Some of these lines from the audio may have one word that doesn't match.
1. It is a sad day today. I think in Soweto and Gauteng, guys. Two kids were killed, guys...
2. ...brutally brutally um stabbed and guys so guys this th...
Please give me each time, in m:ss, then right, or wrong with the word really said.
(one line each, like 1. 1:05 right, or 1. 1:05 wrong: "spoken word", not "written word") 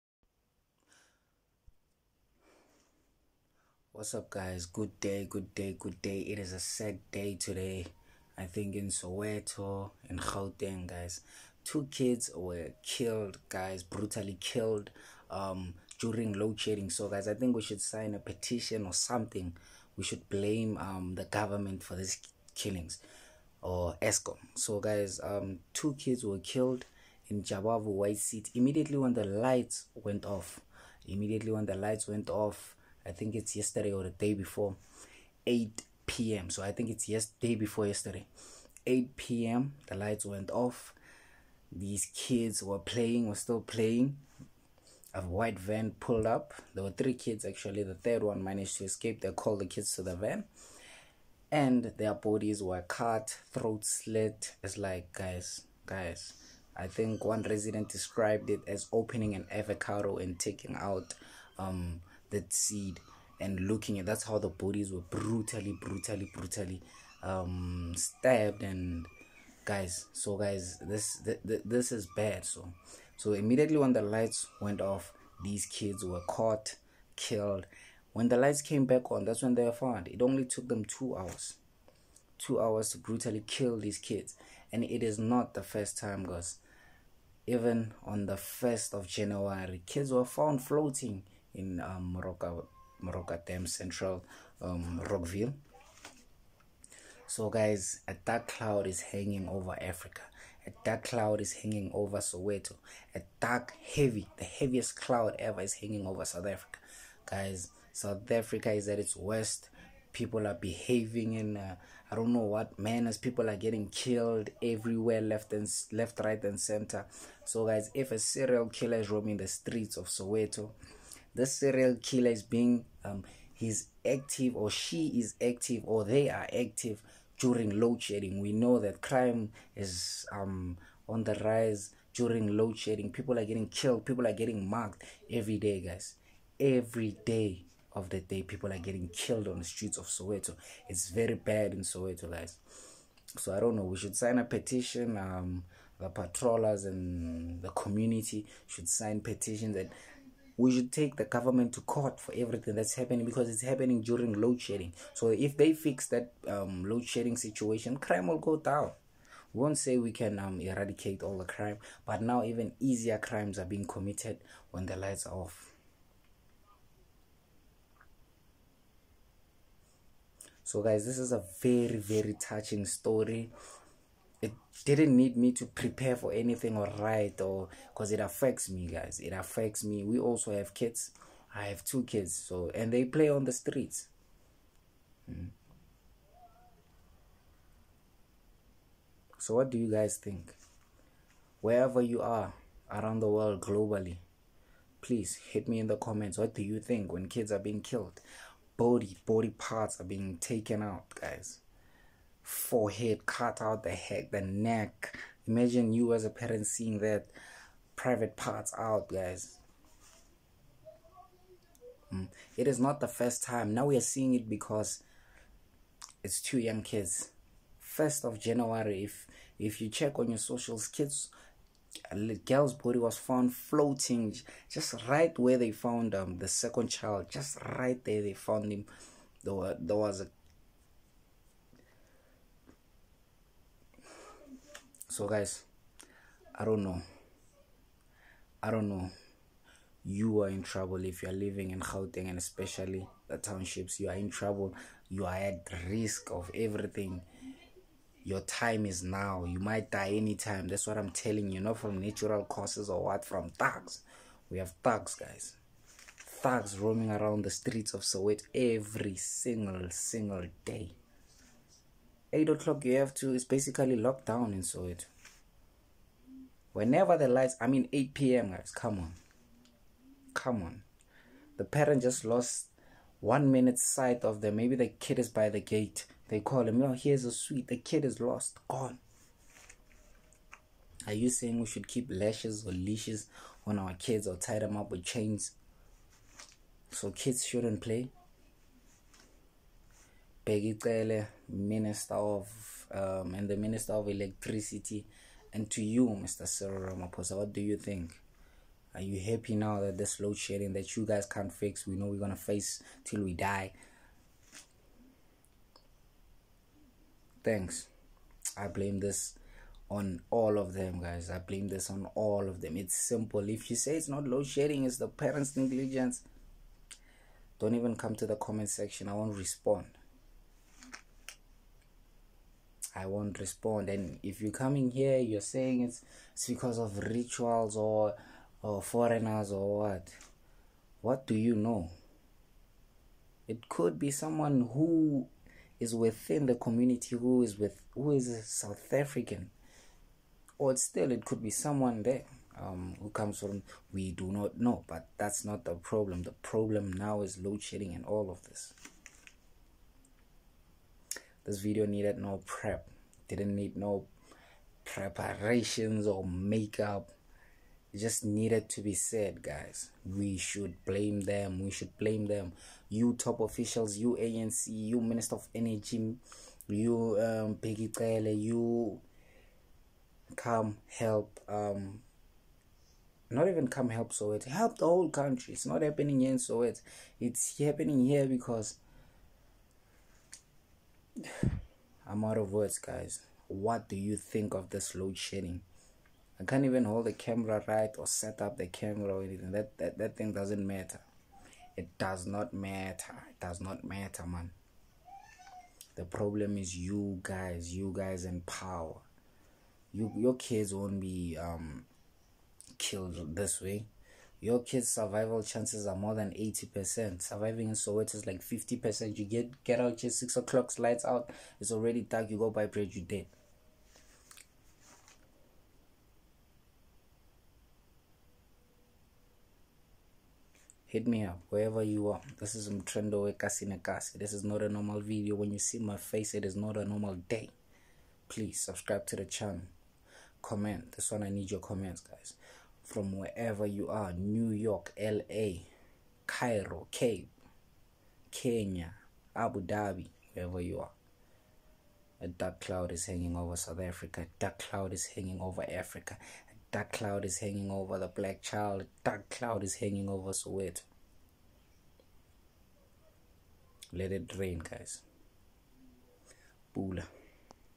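1. 0:06 right
2. 1:05 right.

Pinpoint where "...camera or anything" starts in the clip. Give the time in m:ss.
6:28.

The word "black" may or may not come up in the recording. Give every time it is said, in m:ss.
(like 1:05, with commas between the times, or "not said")
7:28.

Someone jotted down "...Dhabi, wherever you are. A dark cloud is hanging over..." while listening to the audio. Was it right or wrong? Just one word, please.
right.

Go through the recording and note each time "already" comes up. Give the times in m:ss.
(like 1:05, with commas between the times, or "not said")
6:51.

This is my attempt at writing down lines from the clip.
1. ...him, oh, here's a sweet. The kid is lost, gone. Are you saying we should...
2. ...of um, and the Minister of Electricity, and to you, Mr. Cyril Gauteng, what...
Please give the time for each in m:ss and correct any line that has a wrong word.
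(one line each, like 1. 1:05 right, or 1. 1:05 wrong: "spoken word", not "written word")
1. 4:36 right
2. 4:52 wrong: "Ramaphosa", not "Gauteng".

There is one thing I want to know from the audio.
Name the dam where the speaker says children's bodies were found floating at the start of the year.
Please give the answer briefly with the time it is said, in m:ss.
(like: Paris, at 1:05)
Moroka Dam, at 1:33.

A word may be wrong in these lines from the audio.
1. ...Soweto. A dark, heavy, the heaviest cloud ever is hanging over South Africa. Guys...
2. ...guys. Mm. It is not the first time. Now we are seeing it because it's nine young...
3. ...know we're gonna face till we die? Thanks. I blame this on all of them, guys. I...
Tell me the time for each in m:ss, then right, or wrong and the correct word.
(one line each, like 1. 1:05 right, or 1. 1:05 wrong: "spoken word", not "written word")
1. 1:42 right
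2. 3:29 wrong: "two", not "nine"
3. 5:01 right.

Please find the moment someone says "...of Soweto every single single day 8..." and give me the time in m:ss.
4:17.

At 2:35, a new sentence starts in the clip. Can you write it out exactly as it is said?
So if they fix that um, load shedding situation, crime will go down.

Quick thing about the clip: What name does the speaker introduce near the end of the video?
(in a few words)
Mtrendo Ekasinekasi.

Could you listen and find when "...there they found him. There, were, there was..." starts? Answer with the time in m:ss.
3:48.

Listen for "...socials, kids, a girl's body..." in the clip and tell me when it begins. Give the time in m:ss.
3:40.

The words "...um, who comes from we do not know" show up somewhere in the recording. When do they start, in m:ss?
5:42.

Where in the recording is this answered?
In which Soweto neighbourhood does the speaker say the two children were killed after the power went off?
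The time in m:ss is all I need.
0:27.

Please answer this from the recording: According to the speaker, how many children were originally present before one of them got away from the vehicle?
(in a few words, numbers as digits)
3.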